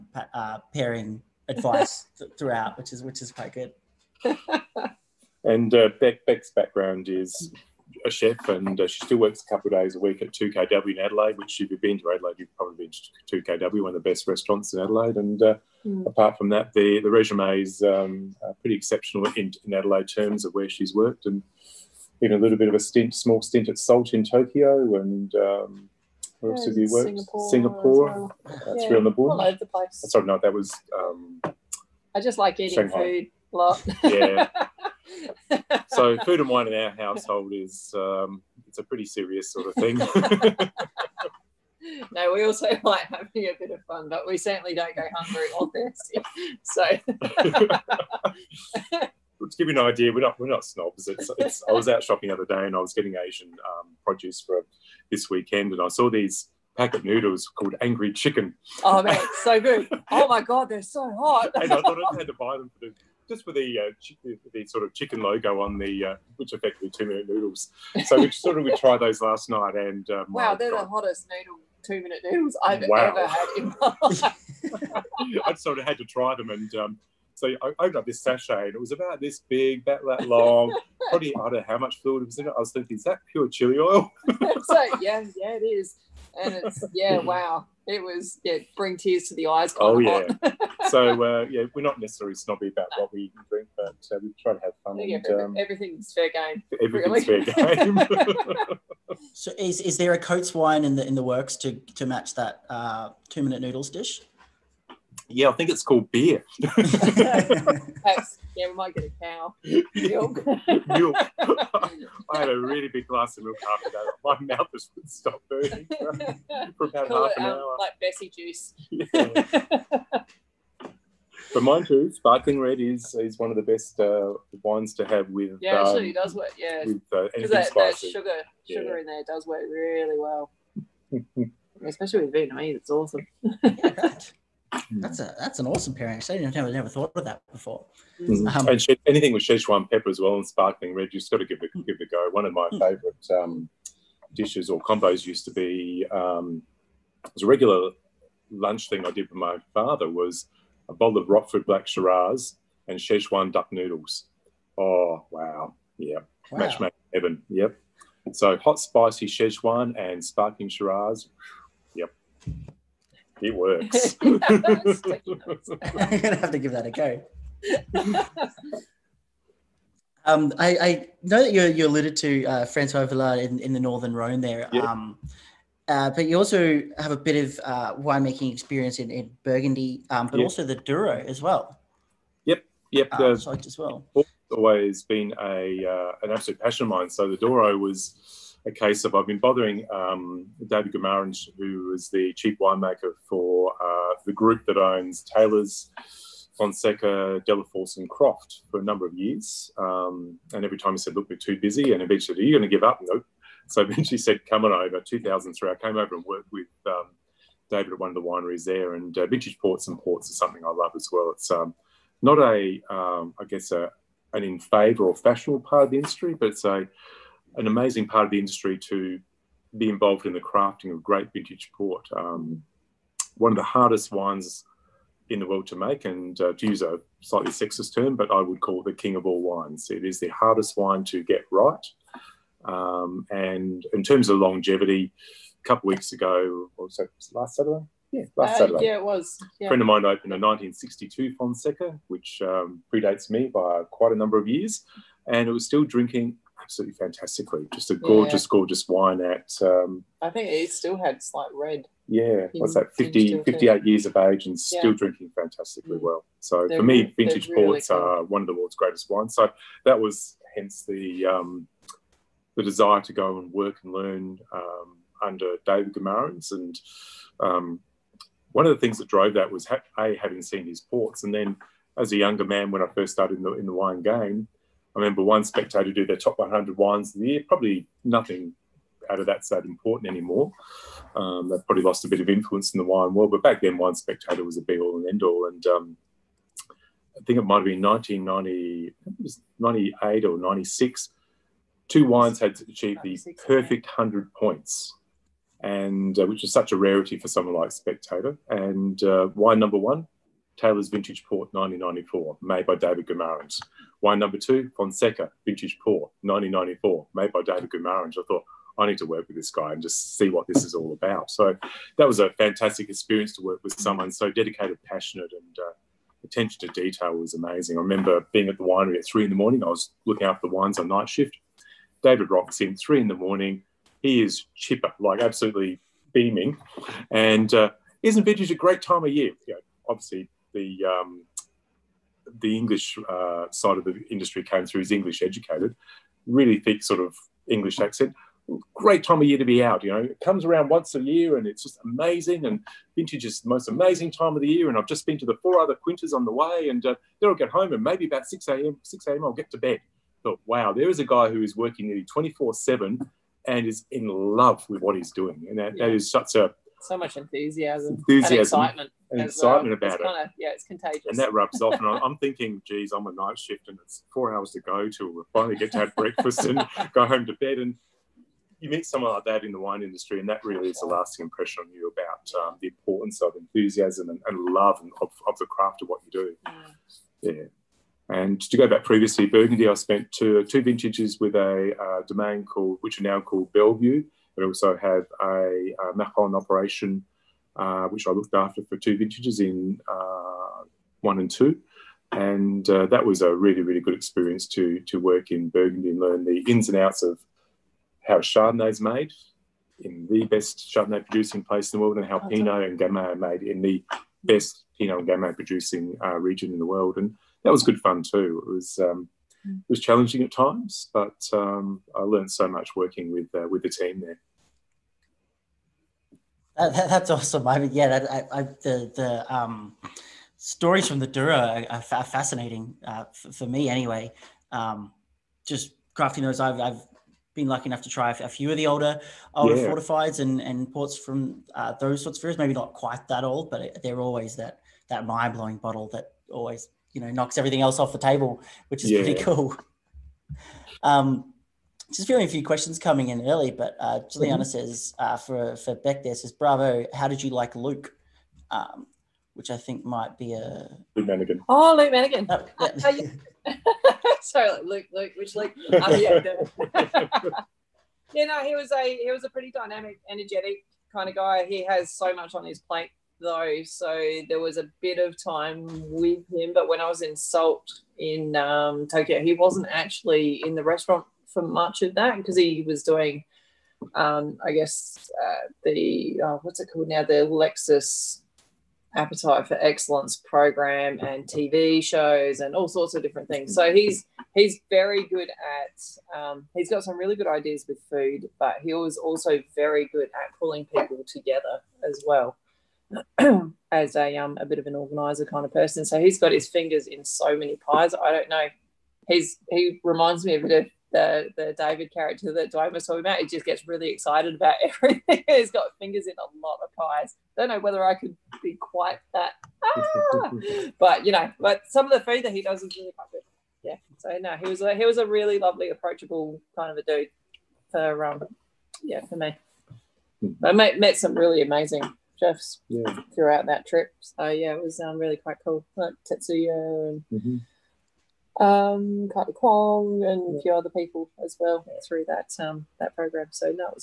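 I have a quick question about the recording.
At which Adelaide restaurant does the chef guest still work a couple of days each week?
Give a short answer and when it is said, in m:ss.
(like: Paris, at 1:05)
2KW, at 0:10.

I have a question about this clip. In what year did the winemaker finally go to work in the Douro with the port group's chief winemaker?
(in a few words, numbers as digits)
2003.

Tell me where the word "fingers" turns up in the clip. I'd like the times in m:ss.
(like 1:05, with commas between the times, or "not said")
8:16, 8:25.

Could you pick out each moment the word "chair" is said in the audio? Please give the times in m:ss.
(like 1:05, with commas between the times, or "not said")
not said.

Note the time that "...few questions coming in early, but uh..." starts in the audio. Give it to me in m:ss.
7:22.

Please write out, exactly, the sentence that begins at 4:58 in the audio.
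And uh, wine number one Taylor's Vintage Port 1994, made by David Guimaraens.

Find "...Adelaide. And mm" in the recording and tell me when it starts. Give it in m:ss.
0:14.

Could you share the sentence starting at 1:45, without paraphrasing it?
yeah, I think it's called beer.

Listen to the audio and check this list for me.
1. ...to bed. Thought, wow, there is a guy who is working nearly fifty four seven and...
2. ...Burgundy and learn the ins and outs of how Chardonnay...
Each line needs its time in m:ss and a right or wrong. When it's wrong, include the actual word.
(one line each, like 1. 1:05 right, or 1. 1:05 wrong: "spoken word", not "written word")
1. 5:49 wrong: "twenty", not "fifty"
2. 6:35 right.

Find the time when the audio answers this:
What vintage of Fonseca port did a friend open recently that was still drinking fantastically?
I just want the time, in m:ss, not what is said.
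4:00.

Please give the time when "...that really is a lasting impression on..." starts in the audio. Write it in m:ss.
6:10.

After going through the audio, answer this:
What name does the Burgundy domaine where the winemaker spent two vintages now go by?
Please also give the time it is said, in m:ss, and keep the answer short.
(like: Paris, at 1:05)
Bellevue, at 6:23.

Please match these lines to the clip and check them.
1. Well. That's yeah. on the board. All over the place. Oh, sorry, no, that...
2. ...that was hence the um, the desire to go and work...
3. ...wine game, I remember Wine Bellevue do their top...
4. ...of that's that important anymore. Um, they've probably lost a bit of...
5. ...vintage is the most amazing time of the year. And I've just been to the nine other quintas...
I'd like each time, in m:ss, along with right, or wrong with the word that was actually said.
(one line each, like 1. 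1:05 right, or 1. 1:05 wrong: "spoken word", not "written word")
1. 0:28 right
2. 4:19 right
3. 4:33 wrong: "Spectator", not "Bellevue"
4. 4:39 right
5. 5:42 wrong: "four", not "nine".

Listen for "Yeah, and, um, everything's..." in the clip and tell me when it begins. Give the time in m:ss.
1:34.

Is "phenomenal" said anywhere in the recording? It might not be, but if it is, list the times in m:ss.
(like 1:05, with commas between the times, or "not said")
not said.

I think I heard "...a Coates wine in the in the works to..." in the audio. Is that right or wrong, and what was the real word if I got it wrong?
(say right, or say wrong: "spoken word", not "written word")
right.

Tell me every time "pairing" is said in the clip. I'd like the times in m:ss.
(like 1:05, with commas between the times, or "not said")
0:00, 2:15.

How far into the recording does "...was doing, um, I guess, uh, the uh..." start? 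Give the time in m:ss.
7:52.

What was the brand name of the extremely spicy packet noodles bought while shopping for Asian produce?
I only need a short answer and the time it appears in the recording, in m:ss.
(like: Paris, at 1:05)
Angry Chicken, at 0:57.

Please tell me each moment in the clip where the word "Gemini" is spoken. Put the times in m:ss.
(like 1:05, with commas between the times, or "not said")
not said.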